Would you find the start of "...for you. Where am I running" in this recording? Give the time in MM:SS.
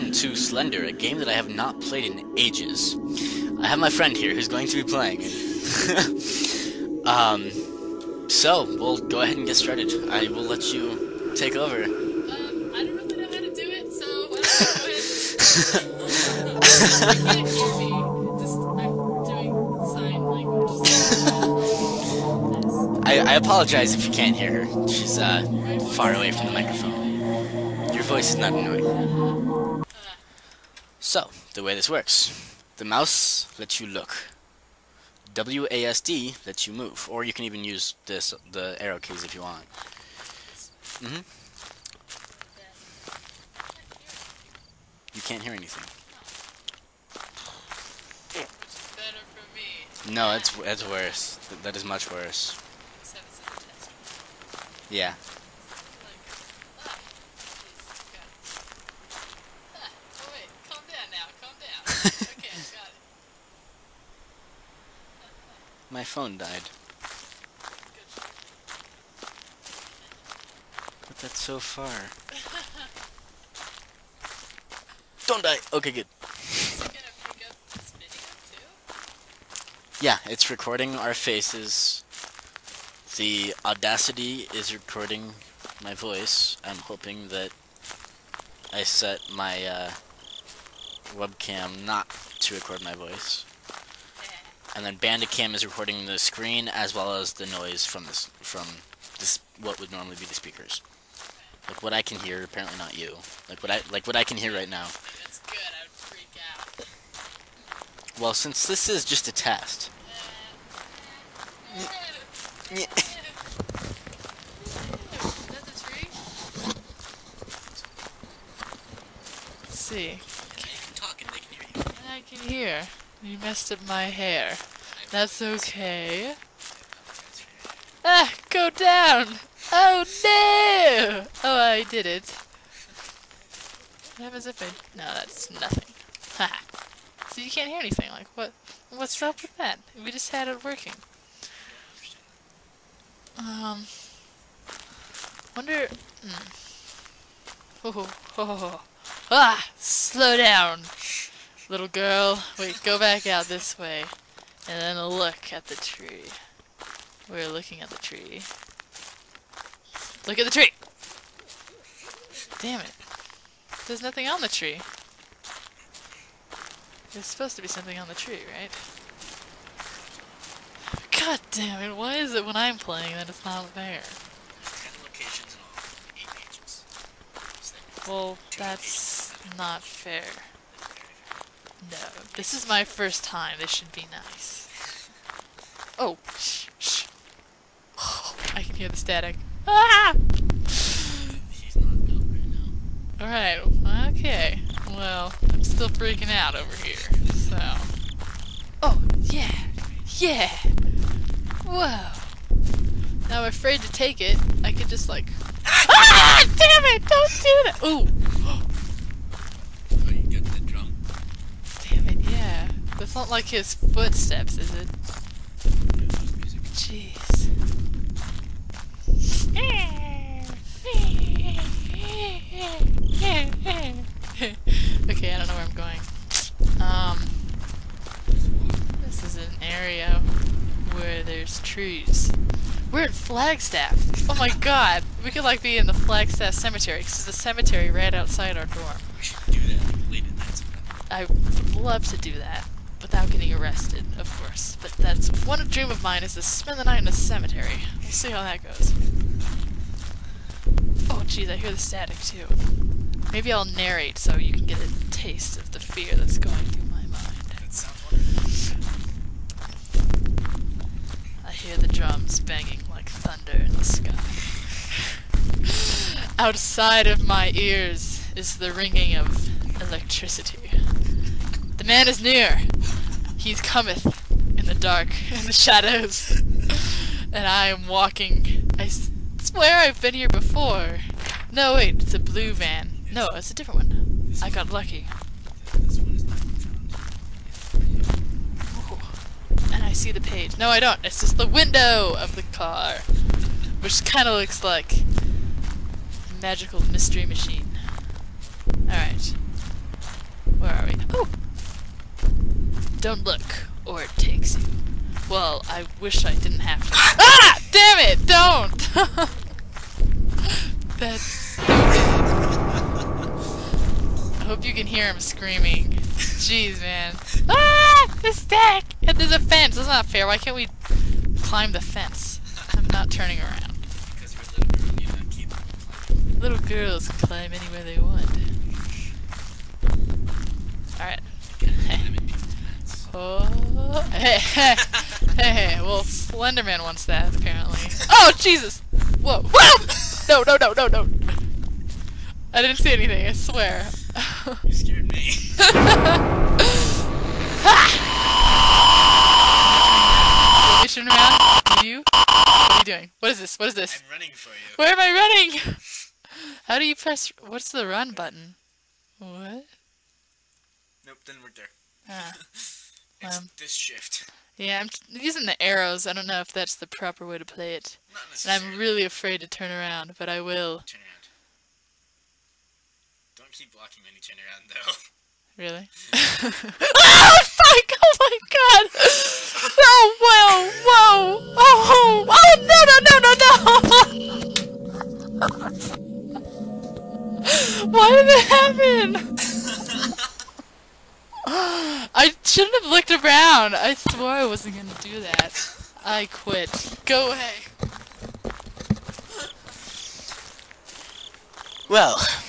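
05:54.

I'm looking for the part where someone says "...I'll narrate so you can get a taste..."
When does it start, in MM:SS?
04:13.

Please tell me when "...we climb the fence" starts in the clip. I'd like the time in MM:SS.
05:20.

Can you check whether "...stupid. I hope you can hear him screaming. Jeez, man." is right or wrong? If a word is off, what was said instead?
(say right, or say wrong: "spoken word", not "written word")
right.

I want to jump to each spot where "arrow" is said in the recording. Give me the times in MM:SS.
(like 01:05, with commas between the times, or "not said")
00:38, 06:05.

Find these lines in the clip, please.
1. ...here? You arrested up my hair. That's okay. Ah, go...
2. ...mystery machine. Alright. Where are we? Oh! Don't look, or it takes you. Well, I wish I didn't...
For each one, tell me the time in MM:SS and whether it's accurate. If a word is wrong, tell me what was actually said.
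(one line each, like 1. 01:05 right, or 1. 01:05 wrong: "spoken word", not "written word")
1. 02:02 wrong: "messed", not "arrested"
2. 04:56 right.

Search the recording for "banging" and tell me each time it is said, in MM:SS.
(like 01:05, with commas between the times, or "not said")
04:22.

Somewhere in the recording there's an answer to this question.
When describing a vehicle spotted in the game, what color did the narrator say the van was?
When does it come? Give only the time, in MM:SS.
04:42.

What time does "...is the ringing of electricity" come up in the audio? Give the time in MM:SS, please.
04:28.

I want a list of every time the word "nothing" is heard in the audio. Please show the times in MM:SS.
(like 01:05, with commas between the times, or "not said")
02:15, 02:44.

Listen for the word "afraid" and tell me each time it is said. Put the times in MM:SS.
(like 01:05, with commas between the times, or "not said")
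03:23, 06:09.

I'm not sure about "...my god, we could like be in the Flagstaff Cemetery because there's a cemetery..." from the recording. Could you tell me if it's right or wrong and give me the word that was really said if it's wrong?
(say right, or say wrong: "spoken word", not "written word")
right.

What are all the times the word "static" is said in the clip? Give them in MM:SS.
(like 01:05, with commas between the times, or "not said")
03:08, 04:11.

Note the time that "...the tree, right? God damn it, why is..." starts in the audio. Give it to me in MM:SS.
02:48.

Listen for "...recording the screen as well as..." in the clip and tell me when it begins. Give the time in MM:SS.
01:35.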